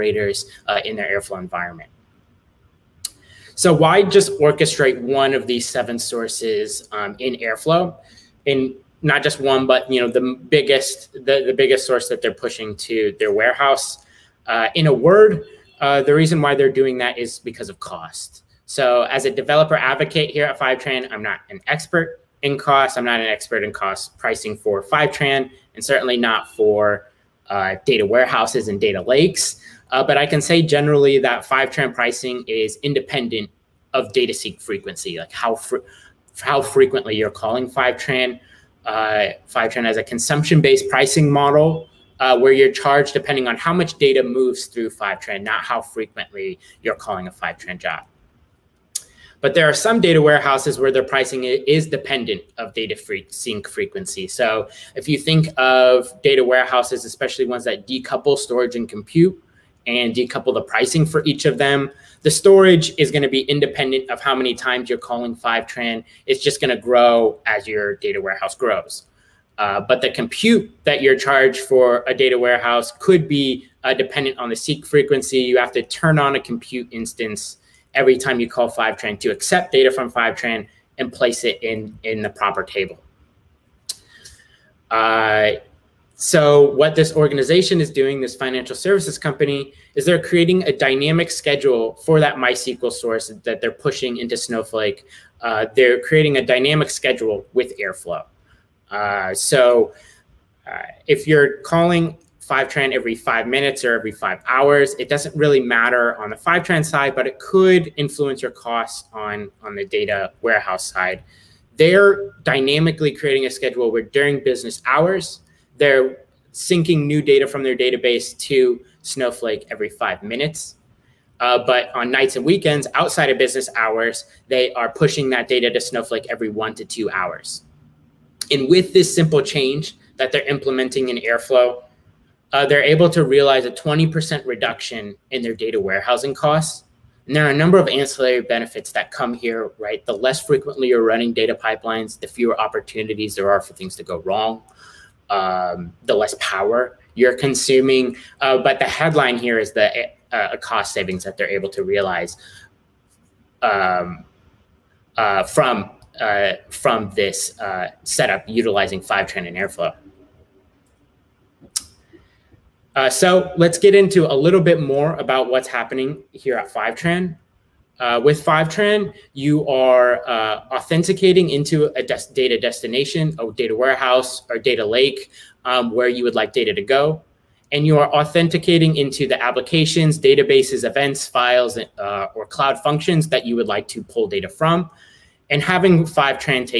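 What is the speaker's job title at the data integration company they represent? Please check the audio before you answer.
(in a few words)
developer advocate.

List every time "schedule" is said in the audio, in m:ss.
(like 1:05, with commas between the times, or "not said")
1:31, 1:36, 1:53.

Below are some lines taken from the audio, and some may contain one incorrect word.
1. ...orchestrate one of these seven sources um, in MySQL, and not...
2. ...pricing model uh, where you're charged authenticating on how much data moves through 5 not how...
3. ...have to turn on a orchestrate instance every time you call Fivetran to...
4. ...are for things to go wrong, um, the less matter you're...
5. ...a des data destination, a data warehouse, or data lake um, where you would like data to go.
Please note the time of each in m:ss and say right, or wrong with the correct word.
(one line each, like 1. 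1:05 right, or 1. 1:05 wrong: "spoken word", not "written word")
1. 0:04 wrong: "Airflow", not "MySQL"
2. 0:40 wrong: "depending", not "authenticating"
3. 1:15 wrong: "compute", not "orchestrate"
4. 2:23 wrong: "power", not "matter"
5. 2:51 right.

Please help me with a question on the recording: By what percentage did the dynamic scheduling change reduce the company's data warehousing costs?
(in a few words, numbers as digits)
20%.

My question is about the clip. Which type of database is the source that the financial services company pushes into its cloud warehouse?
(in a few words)
MySQL.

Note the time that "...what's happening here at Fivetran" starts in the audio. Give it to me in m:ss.
2:45.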